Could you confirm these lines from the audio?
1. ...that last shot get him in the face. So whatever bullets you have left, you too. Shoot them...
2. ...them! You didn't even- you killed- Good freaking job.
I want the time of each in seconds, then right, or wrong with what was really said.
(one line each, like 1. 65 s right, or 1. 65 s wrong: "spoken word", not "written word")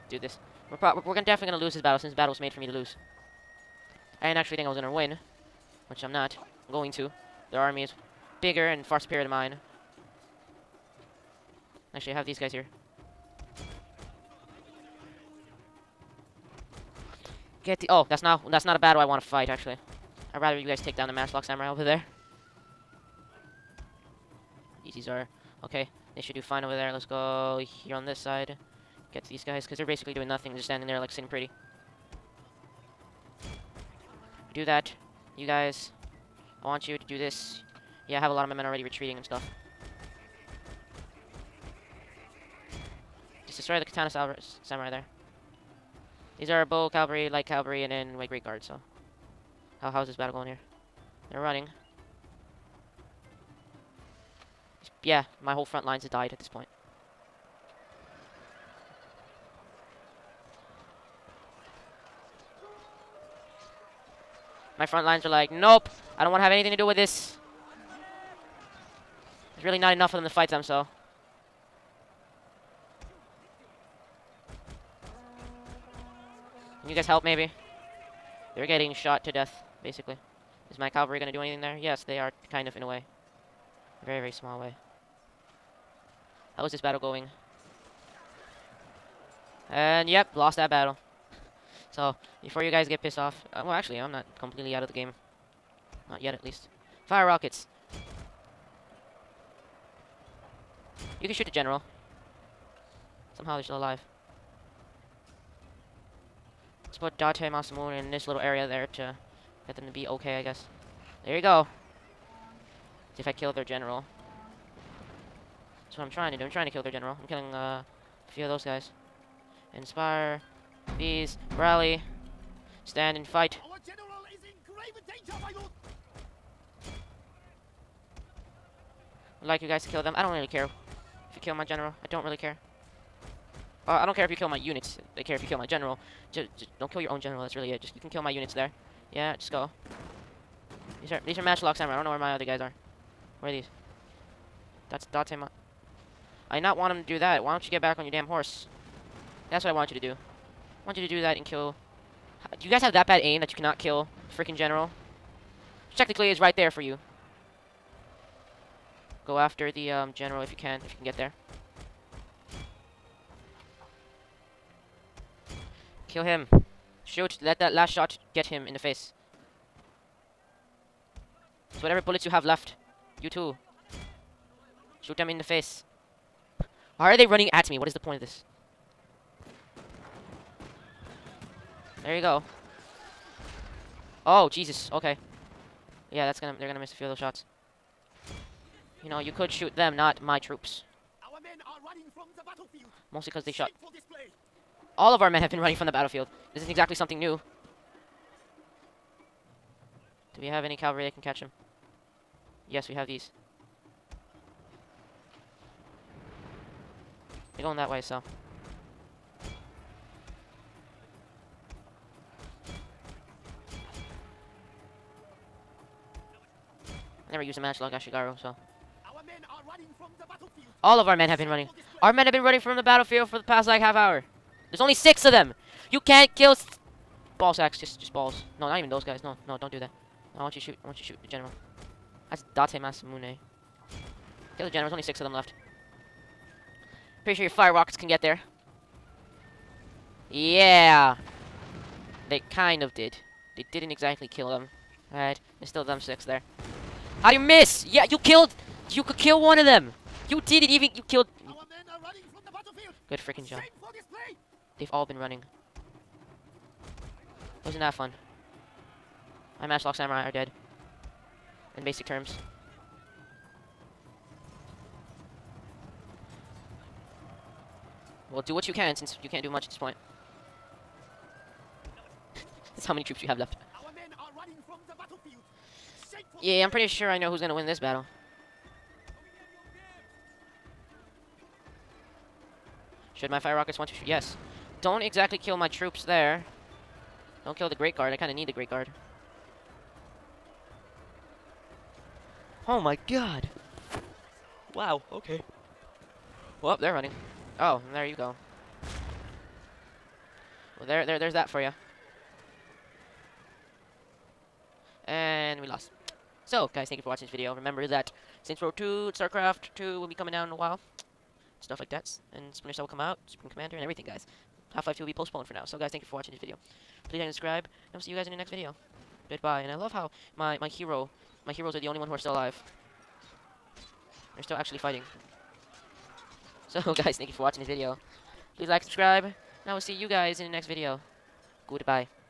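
1. 167 s right
2. 249 s right.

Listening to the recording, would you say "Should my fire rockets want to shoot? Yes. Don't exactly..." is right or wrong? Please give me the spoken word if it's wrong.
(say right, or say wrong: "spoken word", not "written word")
right.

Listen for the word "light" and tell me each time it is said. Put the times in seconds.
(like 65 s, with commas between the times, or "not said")
47 s.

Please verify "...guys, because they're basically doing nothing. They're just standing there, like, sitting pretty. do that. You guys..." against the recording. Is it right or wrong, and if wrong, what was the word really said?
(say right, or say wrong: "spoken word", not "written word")
right.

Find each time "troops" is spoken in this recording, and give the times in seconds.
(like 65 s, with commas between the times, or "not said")
190 s, 273 s, 285 s.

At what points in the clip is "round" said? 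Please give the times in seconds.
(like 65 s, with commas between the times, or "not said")
not said.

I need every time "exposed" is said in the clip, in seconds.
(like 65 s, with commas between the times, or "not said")
not said.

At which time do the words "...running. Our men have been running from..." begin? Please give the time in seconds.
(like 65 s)
221 s.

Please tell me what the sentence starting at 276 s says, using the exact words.
Yeah, I'm pretty sure I know who's going to win this battle.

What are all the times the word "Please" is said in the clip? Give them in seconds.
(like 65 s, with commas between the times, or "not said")
317 s, 328 s.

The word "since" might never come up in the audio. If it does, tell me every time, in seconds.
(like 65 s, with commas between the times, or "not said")
1 s, 268 s.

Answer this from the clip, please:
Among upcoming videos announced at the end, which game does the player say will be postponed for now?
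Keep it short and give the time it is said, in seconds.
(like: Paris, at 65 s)
Half-Life 2, at 314 s.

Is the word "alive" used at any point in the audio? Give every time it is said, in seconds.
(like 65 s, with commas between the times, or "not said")
103 s, 322 s.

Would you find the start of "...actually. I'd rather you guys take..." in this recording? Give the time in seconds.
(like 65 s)
19 s.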